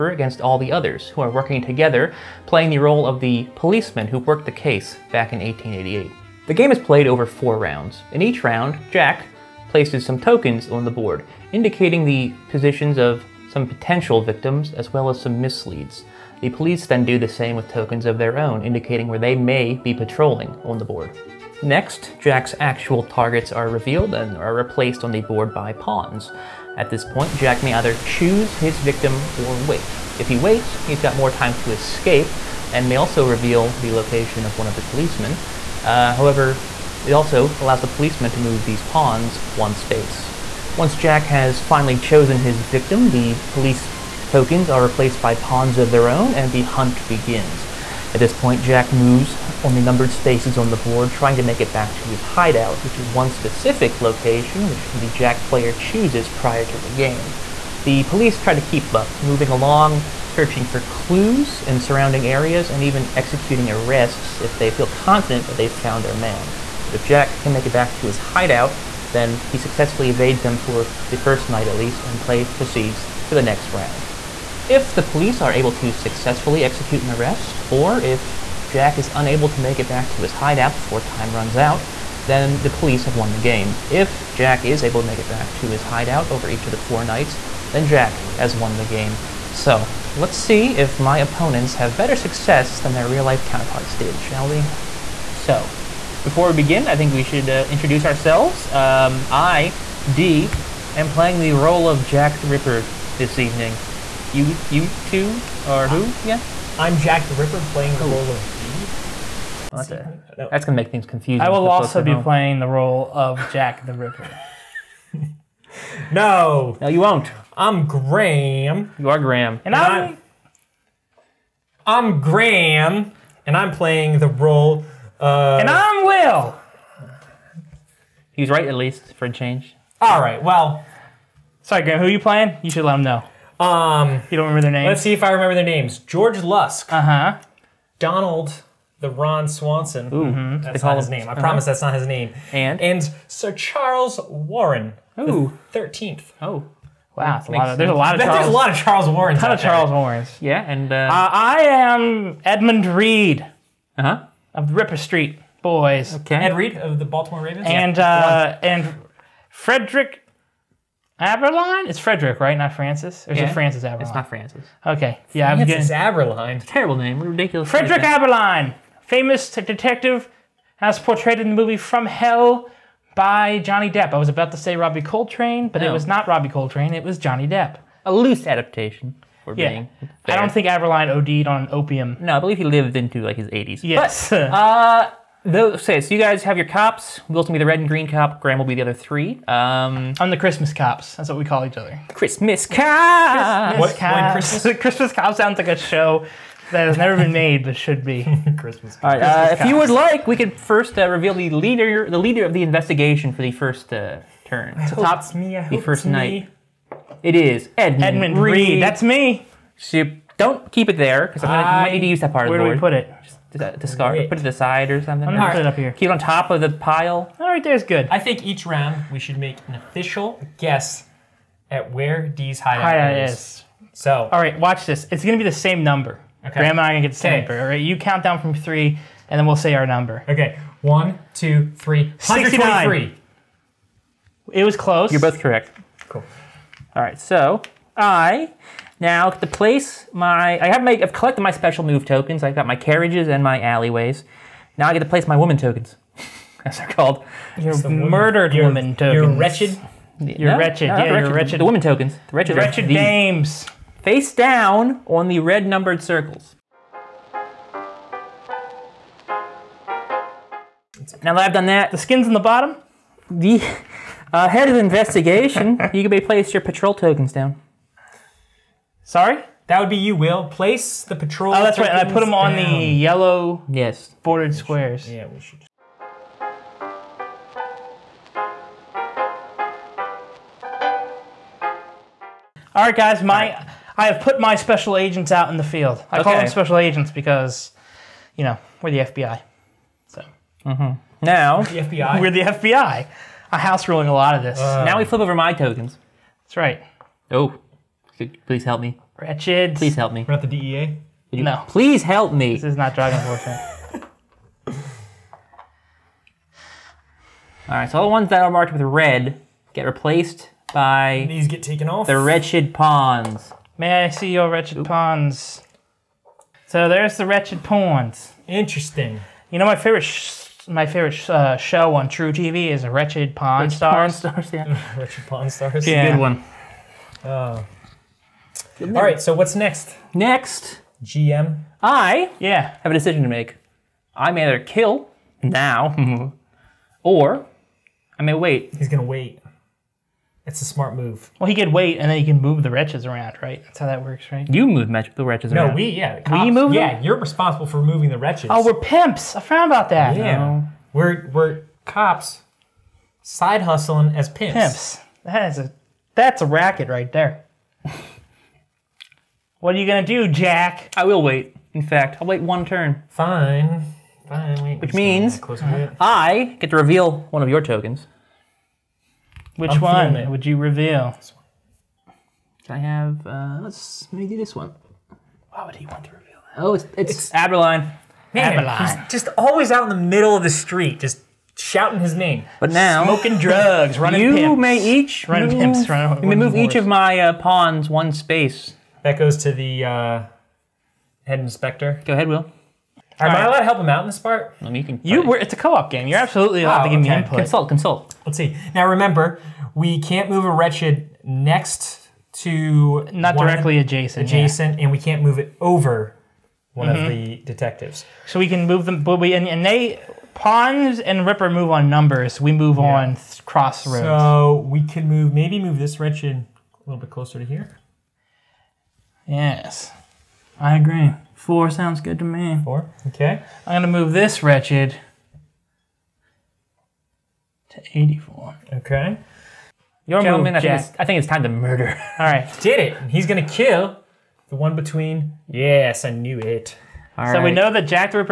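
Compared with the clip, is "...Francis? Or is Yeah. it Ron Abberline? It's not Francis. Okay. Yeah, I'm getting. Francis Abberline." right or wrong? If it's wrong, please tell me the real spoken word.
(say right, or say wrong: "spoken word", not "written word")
wrong: "Francis", not "Ron".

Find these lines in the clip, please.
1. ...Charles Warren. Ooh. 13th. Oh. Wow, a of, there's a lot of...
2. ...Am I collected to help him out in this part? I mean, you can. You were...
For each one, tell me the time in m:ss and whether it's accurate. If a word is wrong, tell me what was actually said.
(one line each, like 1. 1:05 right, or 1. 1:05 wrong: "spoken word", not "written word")
1. 2:23 right
2. 6:33 wrong: "allowed", not "collected".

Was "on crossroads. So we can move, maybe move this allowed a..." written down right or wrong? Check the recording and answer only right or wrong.
wrong.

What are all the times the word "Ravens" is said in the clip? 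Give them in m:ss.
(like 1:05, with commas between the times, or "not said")
2:37.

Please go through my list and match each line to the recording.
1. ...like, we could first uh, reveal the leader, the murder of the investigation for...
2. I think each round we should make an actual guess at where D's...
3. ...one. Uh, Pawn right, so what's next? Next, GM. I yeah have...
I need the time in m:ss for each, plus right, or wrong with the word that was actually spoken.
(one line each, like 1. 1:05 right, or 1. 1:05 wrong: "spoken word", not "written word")
1. 3:19 wrong: "leader", not "murder"
2. 3:38 wrong: "official", not "actual"
3. 5:26 wrong: "All", not "Pawn".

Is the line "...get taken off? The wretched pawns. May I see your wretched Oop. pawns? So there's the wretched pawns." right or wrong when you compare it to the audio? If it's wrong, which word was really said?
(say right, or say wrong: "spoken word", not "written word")
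right.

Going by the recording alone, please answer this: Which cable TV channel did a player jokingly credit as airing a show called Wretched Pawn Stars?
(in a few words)
truTV.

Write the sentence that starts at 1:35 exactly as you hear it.
So, before we begin, I think we should uh, introduce ourselves.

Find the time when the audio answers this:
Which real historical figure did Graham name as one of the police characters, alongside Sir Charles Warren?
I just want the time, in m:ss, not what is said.
2:15.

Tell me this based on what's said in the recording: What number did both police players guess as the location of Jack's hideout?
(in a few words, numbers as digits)
123.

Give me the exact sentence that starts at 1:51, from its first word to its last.
I will also be playing the role of Jack the Ripper.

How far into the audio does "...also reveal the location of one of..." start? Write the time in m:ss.
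0:32.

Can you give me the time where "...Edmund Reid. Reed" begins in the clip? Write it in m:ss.
3:28.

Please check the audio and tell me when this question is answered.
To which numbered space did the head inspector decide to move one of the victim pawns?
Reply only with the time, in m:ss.
7:07.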